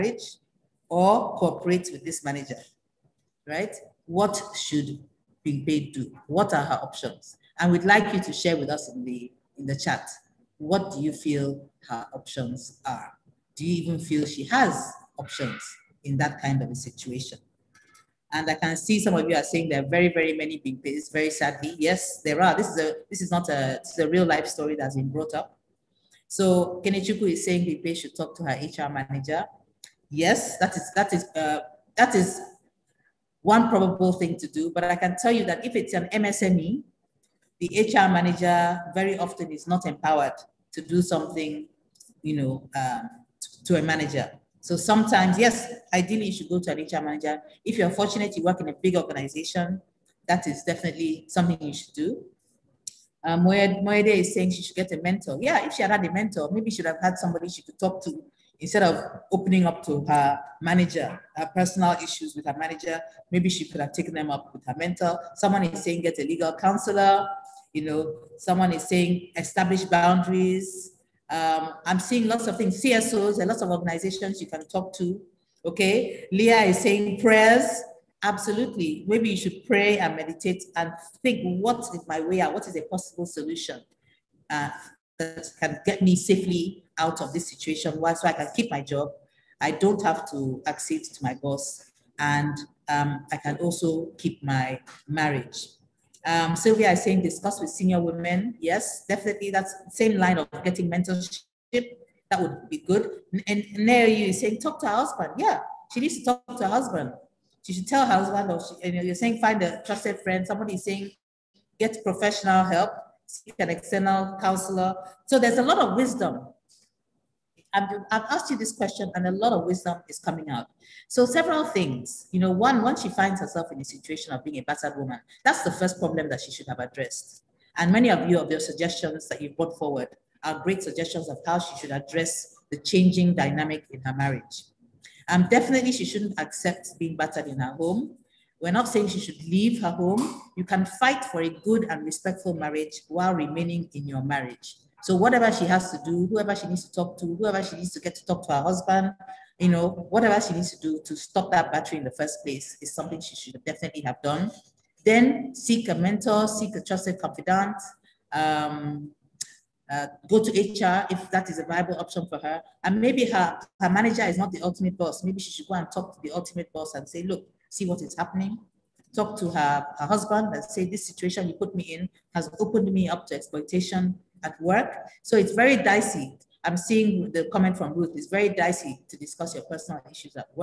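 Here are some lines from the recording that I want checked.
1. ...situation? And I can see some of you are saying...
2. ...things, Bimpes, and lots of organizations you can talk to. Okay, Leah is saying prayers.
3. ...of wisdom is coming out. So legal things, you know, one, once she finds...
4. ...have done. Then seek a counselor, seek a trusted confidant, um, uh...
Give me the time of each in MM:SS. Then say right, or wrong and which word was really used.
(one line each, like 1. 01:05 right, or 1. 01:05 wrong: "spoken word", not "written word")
1. 00:16 right
2. 01:12 wrong: "CSOs", not "Bimpes"
3. 01:59 wrong: "several", not "legal"
4. 02:33 wrong: "mentor", not "counselor".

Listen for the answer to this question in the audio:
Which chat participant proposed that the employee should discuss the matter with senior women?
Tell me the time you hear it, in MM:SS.
01:36.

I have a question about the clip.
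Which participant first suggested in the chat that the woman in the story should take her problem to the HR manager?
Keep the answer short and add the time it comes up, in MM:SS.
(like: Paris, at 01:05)
Kenechukwu, at 00:26.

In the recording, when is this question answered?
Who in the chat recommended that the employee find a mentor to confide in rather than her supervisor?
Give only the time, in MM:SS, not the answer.
00:53.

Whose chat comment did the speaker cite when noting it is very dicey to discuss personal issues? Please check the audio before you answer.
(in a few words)
Ruth.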